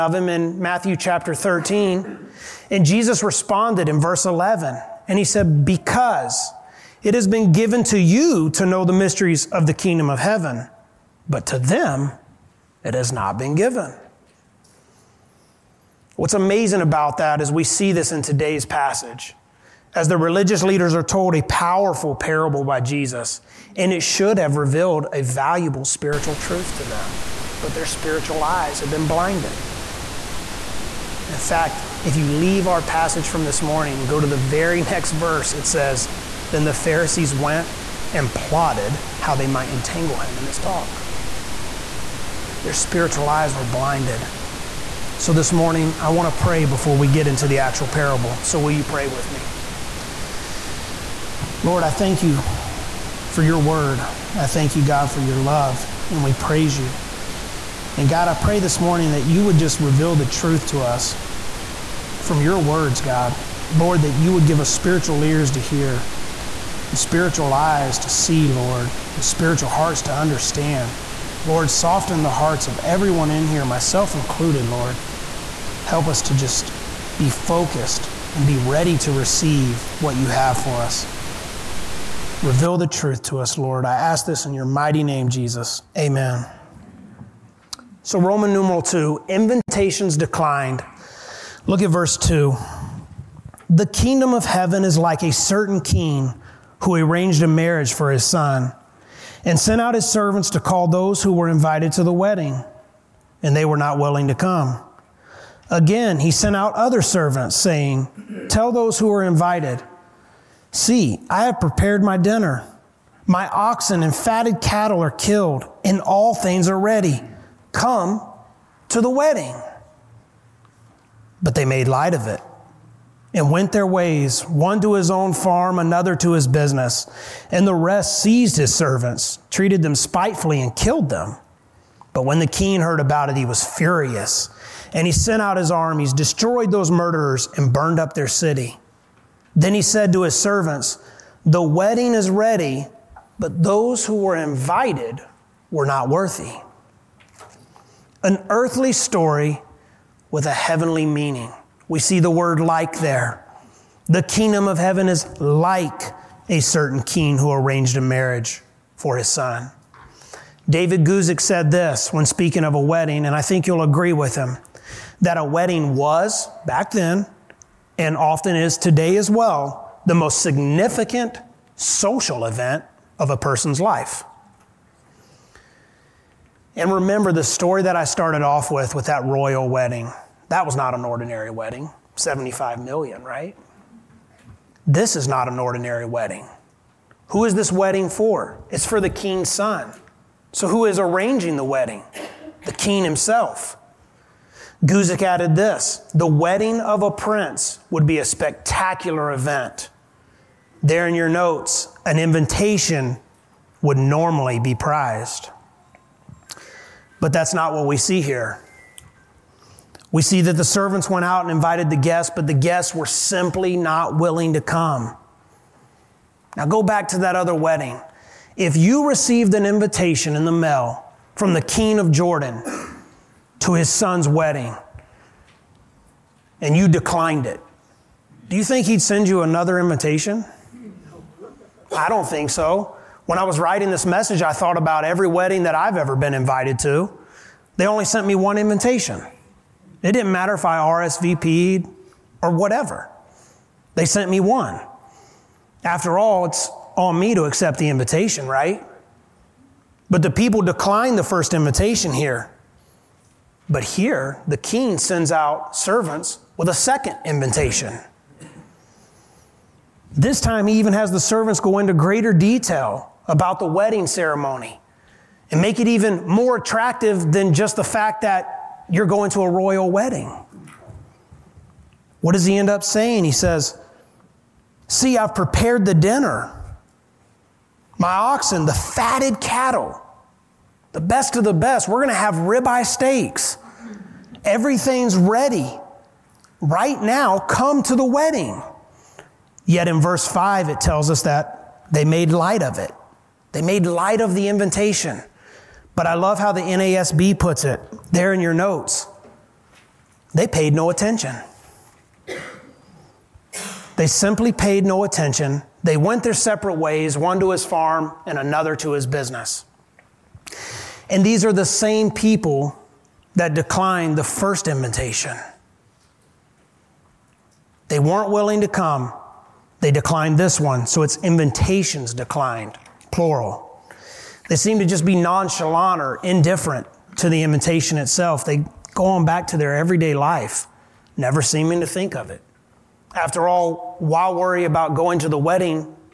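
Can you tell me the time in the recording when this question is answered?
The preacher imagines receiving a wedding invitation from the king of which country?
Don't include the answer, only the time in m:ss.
3:42.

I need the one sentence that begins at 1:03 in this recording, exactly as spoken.
Lord, that you would give us spiritual ears to hear and spiritual eyes to see, Lord, and spiritual hearts to understand.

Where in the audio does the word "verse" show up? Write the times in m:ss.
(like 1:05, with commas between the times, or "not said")
0:03, 0:35, 1:31, 4:50.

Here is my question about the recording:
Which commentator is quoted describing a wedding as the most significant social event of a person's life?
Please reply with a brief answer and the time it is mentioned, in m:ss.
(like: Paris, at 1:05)
David Guzik, at 2:40.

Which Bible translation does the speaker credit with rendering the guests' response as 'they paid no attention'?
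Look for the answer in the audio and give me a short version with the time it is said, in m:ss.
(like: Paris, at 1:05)
NASB, at 4:56.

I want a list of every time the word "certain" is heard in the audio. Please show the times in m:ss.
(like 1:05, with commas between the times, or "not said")
1:35, 2:36.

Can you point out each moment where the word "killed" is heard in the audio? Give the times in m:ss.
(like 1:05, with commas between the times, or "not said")
1:55, 2:10.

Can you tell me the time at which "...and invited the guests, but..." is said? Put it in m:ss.
3:31.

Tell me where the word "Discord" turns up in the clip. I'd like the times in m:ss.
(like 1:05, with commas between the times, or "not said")
not said.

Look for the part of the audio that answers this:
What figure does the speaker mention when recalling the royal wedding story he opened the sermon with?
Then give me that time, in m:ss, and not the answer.
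3:02.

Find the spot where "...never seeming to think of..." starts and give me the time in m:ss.
5:31.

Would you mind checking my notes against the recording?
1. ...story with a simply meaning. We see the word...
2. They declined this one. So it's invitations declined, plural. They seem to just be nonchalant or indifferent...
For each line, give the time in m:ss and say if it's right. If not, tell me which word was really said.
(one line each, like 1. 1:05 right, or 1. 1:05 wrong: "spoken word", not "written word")
1. 2:28 wrong: "heavenly", not "simply"
2. 5:19 right.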